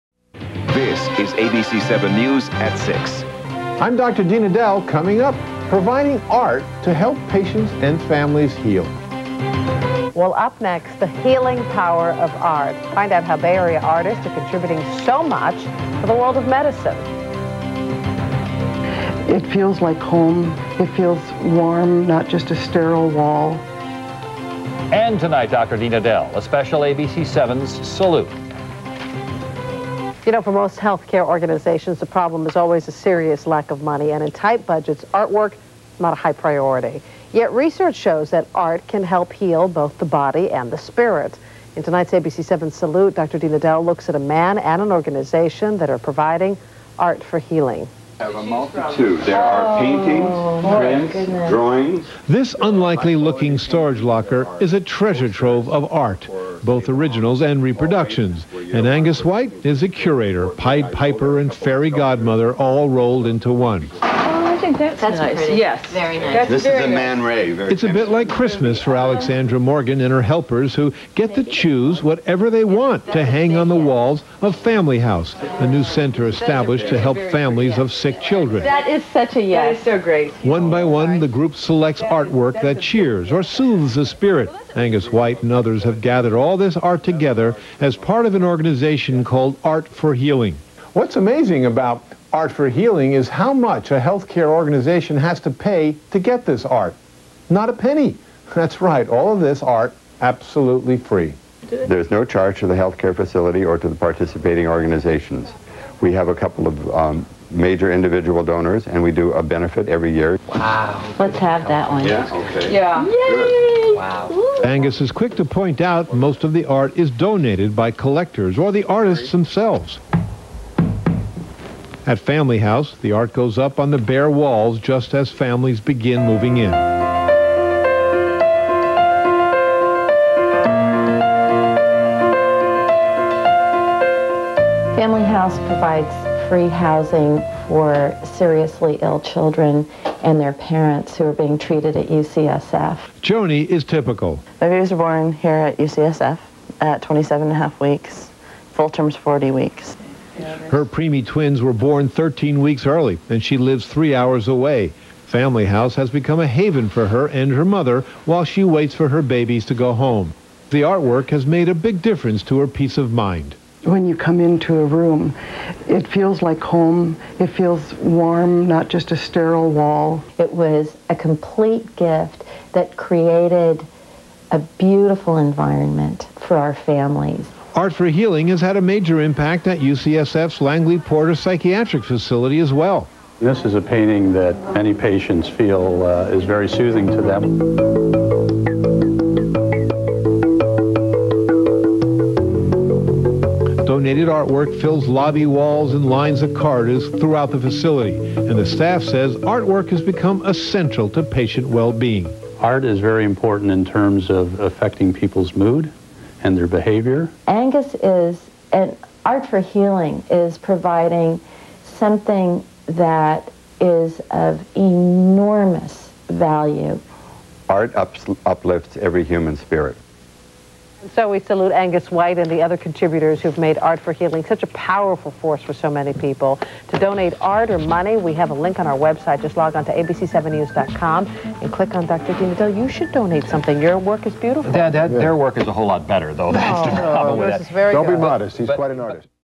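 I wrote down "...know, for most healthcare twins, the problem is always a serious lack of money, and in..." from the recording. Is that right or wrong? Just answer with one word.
wrong.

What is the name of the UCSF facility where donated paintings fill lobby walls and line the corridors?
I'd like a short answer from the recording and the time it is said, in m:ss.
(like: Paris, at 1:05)
Langley Porter Psychiatric Facility, at 3:00.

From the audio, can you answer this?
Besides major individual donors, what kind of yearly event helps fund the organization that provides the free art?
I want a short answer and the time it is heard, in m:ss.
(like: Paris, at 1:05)
A benefit, at 1:49.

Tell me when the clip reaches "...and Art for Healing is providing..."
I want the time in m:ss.
3:28.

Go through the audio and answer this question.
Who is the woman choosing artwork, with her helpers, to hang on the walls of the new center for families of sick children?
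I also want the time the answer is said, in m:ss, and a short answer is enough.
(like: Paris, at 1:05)
Alexandra Morgan, at 1:09.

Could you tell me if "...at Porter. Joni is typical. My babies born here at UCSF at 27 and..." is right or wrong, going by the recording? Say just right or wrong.
wrong.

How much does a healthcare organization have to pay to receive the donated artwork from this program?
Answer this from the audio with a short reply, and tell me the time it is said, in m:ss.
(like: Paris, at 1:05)
Not a penny, at 1:37.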